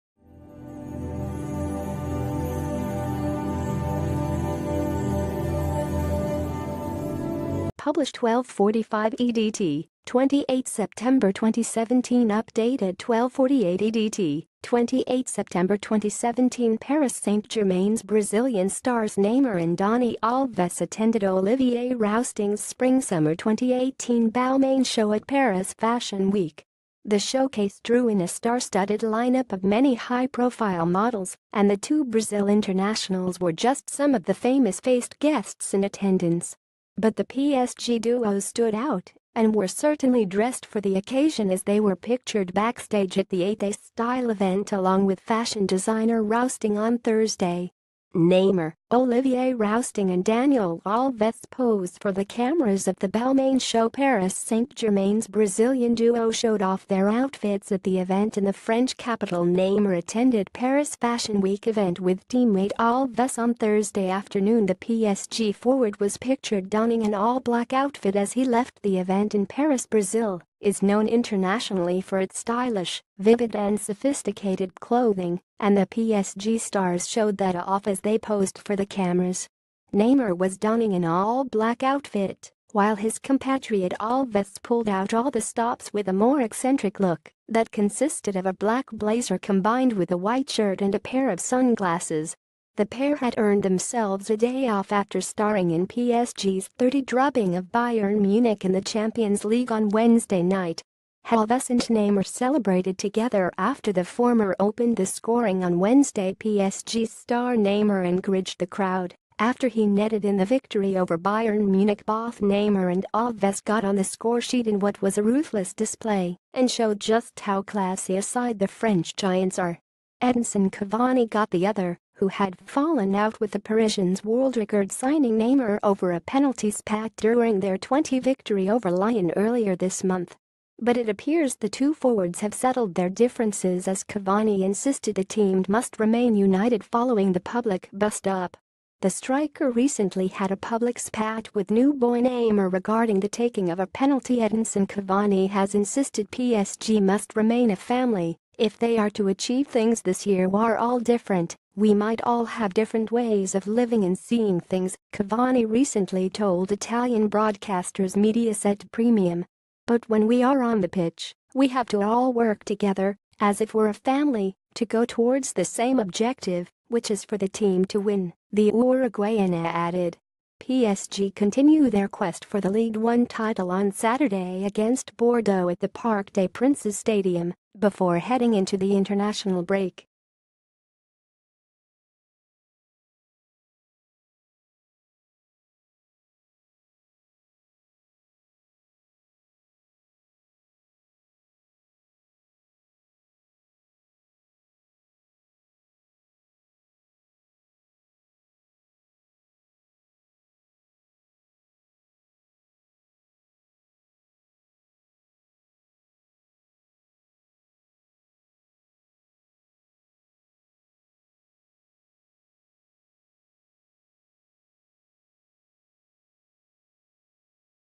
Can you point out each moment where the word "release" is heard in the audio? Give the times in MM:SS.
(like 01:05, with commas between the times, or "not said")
not said.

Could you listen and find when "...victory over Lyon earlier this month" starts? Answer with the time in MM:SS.
02:08.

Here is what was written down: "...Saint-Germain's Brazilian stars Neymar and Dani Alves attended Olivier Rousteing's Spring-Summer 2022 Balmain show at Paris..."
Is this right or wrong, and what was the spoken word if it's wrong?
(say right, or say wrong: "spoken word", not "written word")
wrong: "2018", not "2022".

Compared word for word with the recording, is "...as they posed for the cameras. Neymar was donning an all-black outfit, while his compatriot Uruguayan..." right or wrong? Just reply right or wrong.
wrong.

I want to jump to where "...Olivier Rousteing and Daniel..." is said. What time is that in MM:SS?
00:48.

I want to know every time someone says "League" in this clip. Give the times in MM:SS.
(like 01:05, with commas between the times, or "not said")
01:39, 02:52.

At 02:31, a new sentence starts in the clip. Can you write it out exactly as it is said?
We might all have different ways of living and seeing things, Cavani recently told Italian broadcasters Mediaset Premium.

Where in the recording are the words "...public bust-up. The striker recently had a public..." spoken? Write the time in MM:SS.
02:17.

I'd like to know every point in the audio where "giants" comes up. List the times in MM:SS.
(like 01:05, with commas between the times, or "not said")
01:59.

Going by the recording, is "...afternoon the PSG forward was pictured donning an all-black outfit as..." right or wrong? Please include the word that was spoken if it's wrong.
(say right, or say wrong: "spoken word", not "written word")
right.